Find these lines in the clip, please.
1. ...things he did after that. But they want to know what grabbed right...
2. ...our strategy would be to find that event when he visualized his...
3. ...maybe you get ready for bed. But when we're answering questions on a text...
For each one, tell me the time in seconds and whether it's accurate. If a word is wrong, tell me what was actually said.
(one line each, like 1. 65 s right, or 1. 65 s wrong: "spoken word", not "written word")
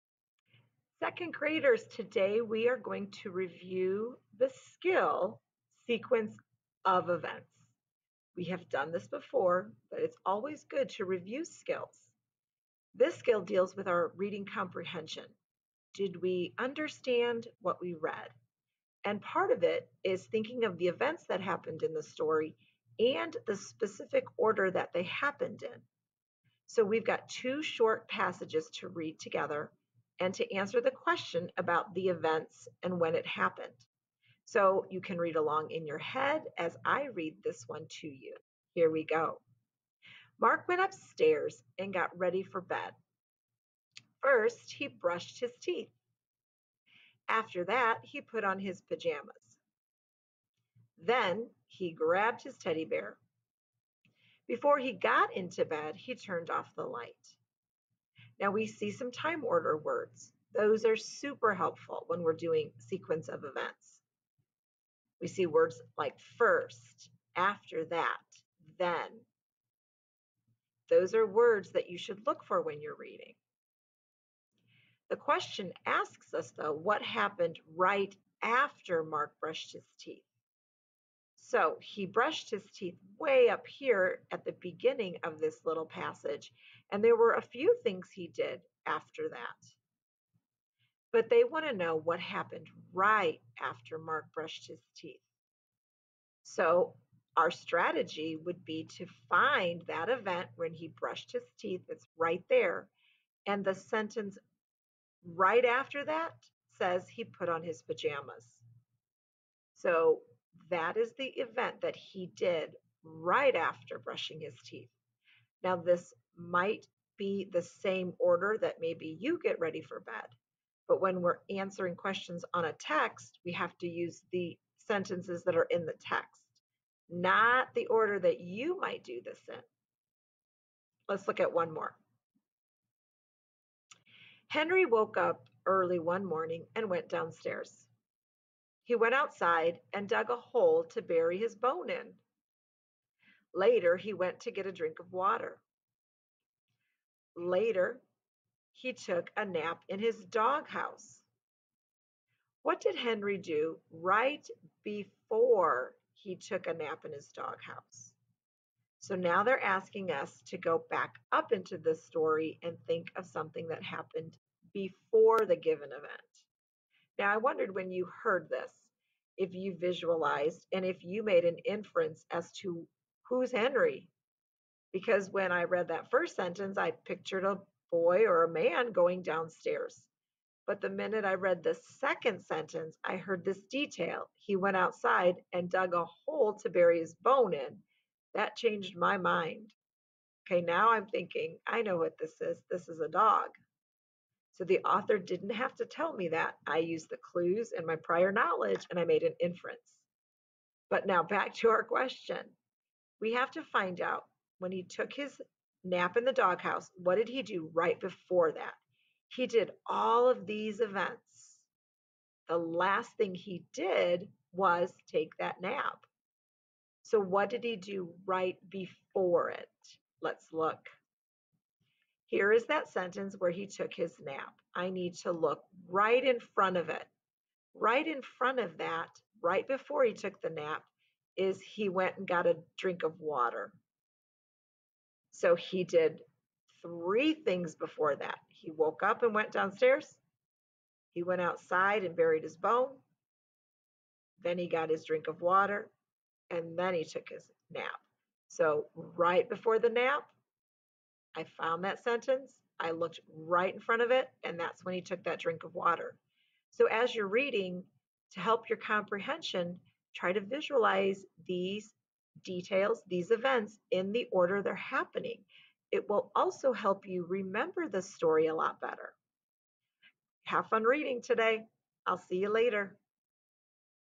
1. 87 s wrong: "happened", not "grabbed"
2. 97 s wrong: "brushed", not "visualized"
3. 118 s right.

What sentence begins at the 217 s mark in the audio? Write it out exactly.
So, what did he do right before it?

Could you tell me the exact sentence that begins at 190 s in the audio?
Okay, now I'm thinking, I know what this is.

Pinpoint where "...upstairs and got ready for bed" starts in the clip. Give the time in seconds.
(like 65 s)
40 s.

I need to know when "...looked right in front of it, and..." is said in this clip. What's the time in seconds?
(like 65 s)
252 s.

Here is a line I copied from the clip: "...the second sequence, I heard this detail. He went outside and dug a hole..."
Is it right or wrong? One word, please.
wrong.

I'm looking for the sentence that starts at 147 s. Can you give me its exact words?
Later, he took a nap in his doghouse.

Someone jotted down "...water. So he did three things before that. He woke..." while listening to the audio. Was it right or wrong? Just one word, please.
right.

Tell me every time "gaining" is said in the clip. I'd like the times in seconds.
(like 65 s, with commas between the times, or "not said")
not said.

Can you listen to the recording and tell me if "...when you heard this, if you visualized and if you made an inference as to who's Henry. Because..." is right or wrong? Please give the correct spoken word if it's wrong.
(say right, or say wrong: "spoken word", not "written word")
right.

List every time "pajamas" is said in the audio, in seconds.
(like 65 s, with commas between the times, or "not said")
48 s, 107 s.